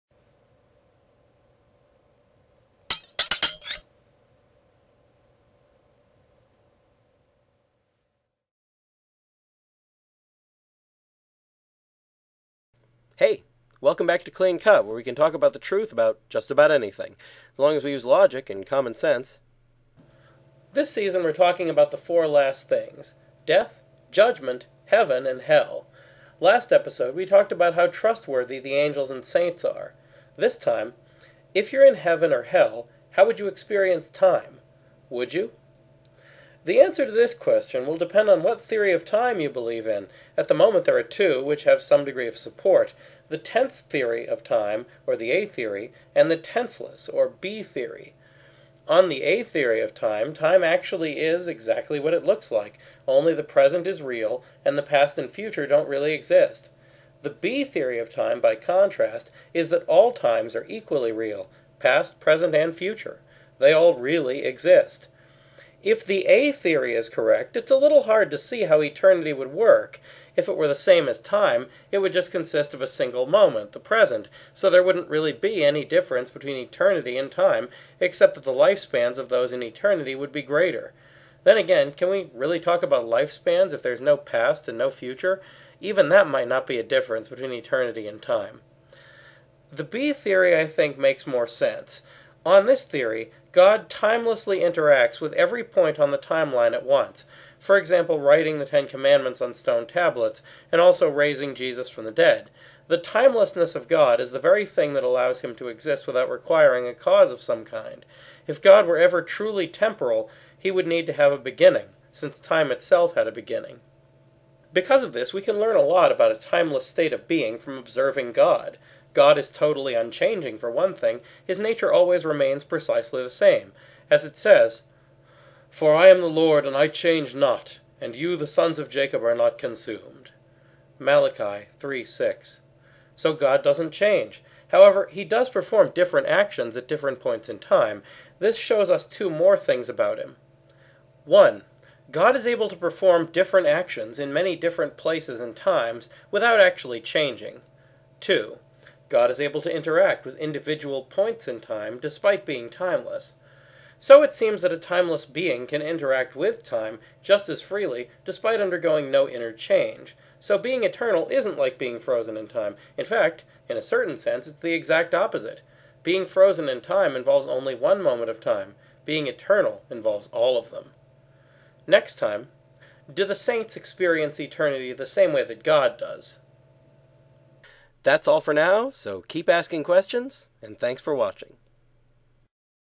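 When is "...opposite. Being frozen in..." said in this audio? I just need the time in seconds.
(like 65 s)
165 s.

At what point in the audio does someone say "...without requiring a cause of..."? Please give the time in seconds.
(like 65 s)
106 s.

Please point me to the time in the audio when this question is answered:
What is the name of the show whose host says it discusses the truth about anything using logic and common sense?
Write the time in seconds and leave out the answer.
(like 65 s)
14 s.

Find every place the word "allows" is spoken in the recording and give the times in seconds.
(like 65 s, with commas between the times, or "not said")
105 s.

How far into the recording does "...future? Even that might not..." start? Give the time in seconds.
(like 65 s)
84 s.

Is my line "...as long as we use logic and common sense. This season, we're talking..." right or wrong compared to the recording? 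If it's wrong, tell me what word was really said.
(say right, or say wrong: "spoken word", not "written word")
right.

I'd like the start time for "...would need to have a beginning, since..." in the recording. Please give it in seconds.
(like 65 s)
110 s.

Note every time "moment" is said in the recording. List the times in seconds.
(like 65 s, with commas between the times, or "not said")
40 s, 73 s, 168 s.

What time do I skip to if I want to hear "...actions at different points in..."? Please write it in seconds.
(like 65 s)
136 s.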